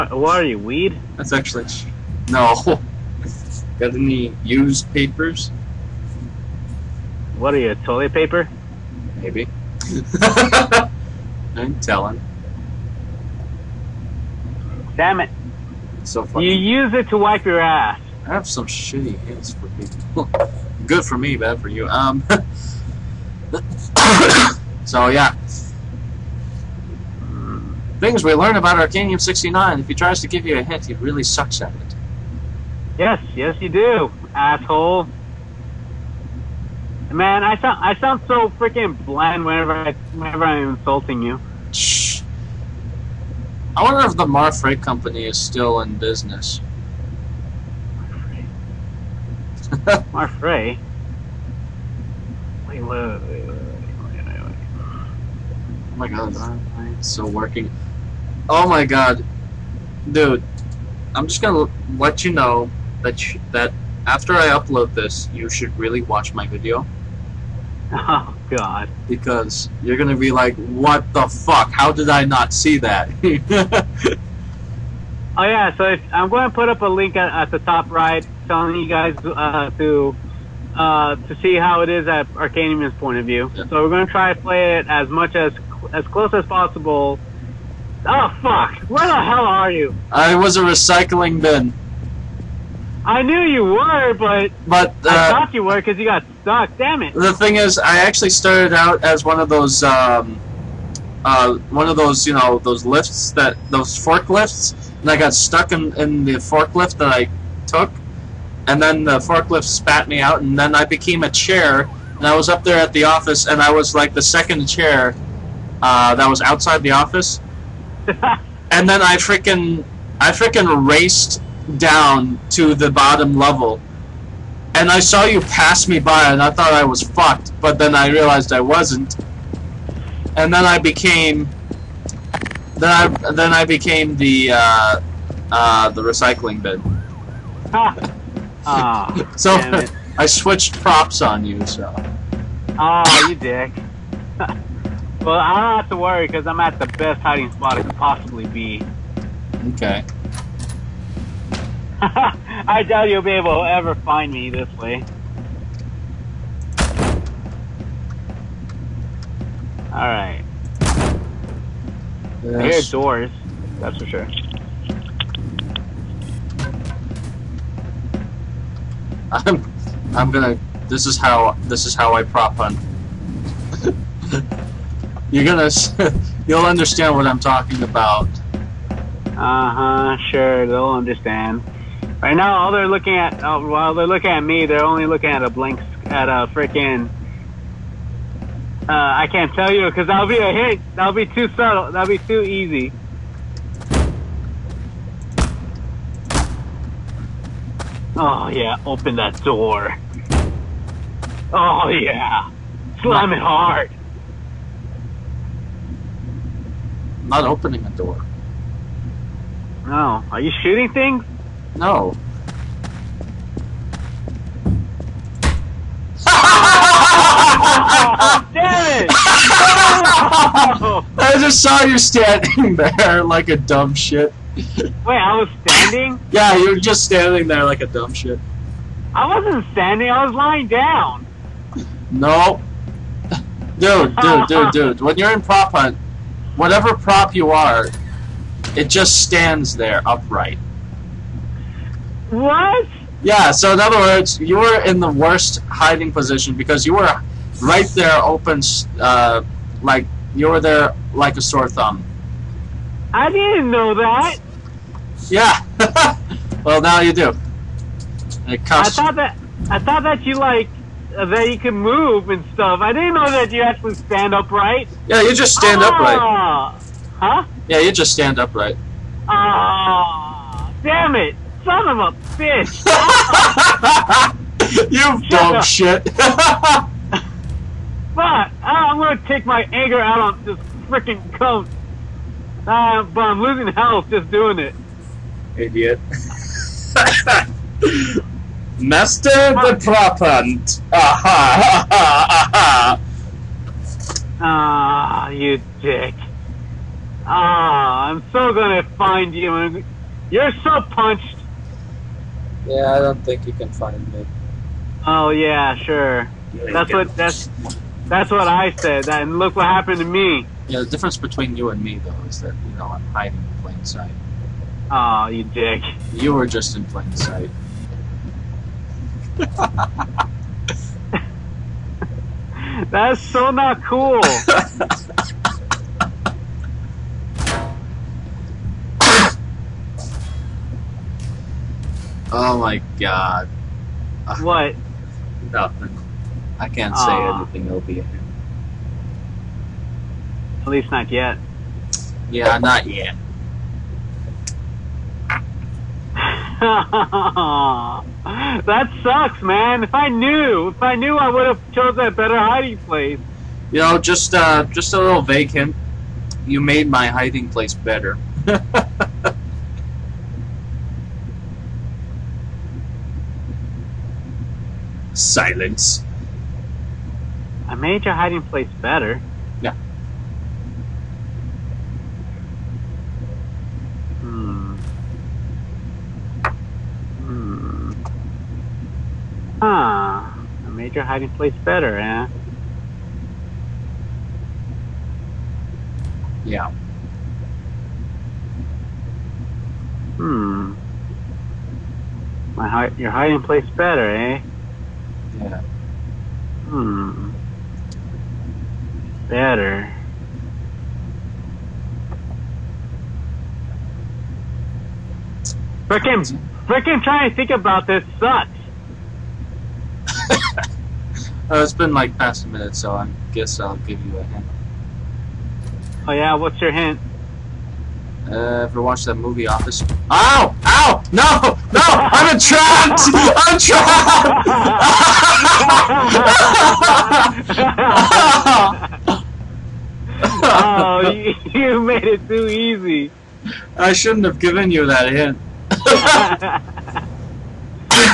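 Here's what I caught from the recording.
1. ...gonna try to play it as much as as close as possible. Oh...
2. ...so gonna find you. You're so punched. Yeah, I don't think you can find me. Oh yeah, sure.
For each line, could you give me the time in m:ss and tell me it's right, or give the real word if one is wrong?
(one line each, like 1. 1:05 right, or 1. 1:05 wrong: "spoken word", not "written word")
1. 1:23 right
2. 4:58 right.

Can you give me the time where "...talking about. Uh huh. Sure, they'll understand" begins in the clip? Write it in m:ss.
2:57.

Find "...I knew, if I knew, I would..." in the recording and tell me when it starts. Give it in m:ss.
5:49.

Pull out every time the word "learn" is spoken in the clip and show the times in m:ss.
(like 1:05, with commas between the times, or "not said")
0:28.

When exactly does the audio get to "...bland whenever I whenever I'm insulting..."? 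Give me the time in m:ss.
0:39.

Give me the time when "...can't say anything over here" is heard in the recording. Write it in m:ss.
5:36.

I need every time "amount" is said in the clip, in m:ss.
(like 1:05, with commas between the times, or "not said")
not said.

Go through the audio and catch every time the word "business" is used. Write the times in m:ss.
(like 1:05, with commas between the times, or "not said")
0:45.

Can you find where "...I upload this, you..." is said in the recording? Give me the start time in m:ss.
1:04.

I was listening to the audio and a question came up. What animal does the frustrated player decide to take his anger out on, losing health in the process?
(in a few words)
goat.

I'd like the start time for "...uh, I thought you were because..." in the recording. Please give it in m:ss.
1:35.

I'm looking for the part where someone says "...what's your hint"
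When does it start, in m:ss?
6:56.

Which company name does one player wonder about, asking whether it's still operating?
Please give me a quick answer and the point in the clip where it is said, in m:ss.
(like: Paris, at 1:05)
Mar Freight Company, at 0:44.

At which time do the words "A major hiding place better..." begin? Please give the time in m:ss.
6:20.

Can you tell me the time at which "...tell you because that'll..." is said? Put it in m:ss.
3:09.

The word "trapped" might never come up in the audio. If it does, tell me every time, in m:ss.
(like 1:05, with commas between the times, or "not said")
7:02, 7:10.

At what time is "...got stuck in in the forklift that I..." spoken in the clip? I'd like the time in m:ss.
1:45.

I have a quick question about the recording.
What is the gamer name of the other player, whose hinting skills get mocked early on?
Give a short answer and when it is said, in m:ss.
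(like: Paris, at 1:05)
Arcanium 69, at 0:28.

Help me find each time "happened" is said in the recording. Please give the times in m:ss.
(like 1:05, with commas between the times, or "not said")
5:09.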